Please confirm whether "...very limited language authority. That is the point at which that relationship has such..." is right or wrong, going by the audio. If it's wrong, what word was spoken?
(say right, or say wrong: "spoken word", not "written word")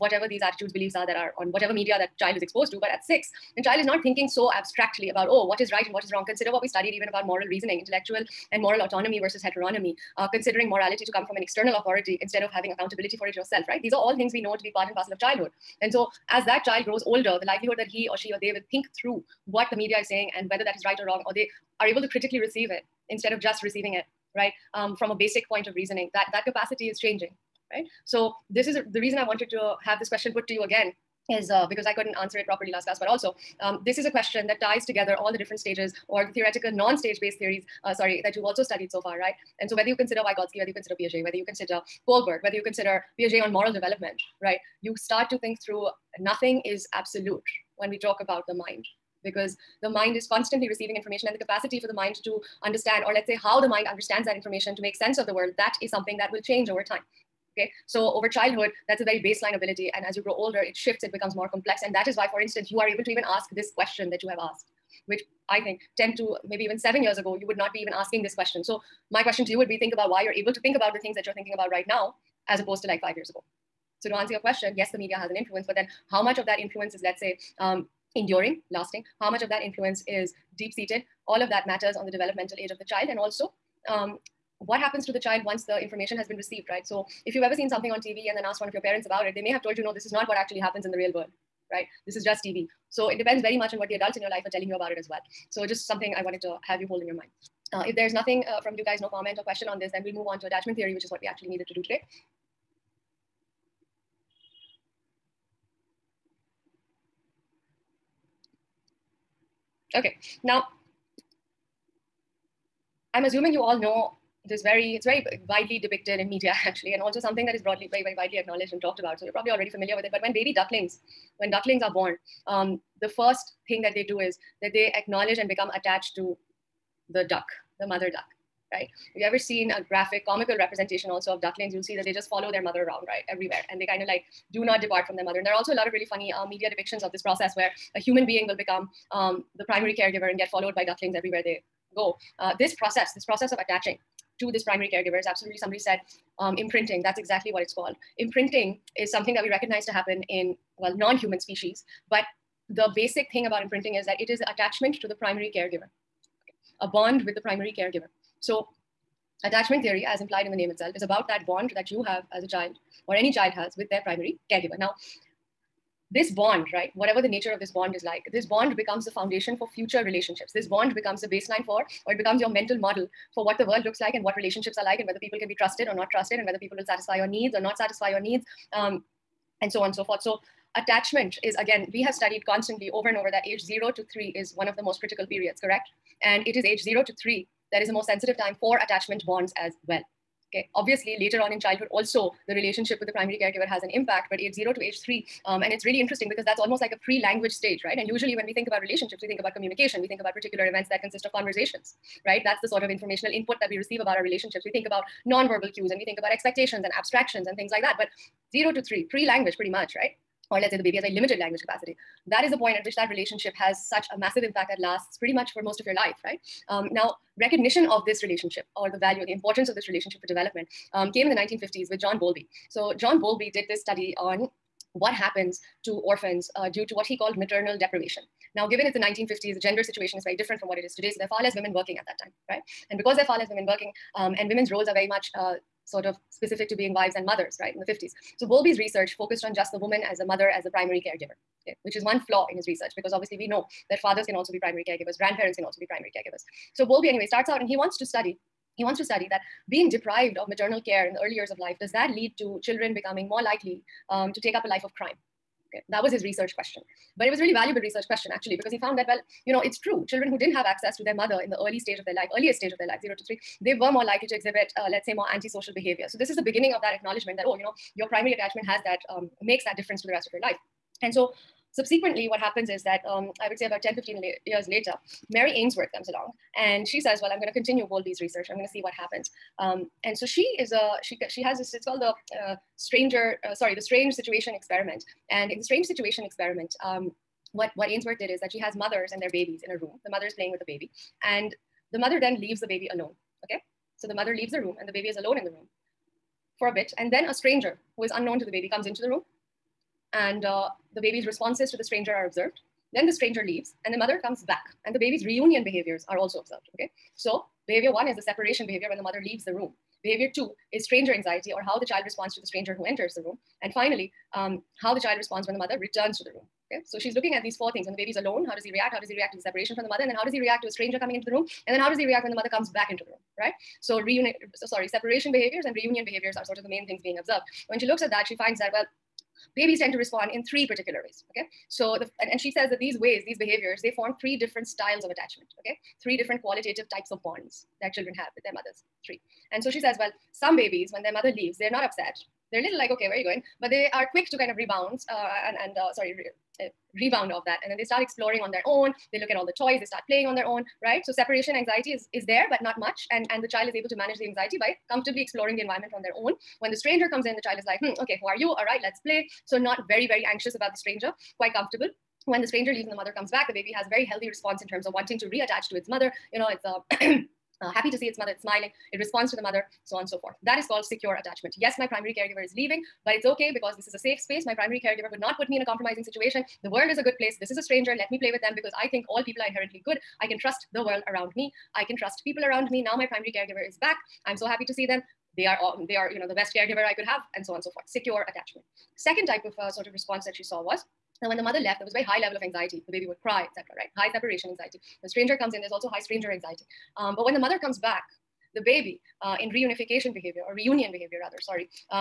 wrong: "capacity", not "authority".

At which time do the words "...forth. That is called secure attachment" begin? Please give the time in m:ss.
6:10.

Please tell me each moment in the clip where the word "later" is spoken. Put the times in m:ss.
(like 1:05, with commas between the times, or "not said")
3:11, 4:34.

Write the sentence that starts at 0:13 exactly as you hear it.
These are all things we know to be part and parcel of childhood.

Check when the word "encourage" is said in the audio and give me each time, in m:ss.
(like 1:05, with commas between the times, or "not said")
not said.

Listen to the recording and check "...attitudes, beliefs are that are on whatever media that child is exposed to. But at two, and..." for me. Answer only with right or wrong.
wrong.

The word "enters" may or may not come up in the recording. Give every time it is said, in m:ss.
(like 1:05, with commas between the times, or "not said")
5:12.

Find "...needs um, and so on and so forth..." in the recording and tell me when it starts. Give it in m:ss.
2:58.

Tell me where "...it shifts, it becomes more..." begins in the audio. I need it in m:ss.
1:00.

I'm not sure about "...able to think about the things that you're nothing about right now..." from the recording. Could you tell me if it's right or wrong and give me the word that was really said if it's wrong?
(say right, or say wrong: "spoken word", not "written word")
wrong: "thinking", not "nothing".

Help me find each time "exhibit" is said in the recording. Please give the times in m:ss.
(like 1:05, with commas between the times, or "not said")
4:24.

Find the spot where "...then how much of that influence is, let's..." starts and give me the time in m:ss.
1:15.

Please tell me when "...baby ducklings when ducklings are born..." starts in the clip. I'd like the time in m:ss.
2:00.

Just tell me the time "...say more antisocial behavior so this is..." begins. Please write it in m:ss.
4:25.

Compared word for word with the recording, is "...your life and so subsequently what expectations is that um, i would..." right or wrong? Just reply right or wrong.
wrong.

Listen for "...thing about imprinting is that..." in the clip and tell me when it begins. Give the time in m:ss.
2:33.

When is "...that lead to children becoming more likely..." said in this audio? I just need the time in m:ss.
4:11.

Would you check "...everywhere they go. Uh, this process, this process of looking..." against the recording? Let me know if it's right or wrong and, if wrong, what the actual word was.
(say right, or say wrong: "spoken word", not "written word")
wrong: "attaching", not "looking".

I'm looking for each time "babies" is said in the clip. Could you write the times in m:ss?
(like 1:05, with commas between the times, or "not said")
4:49, 5:29, 5:40.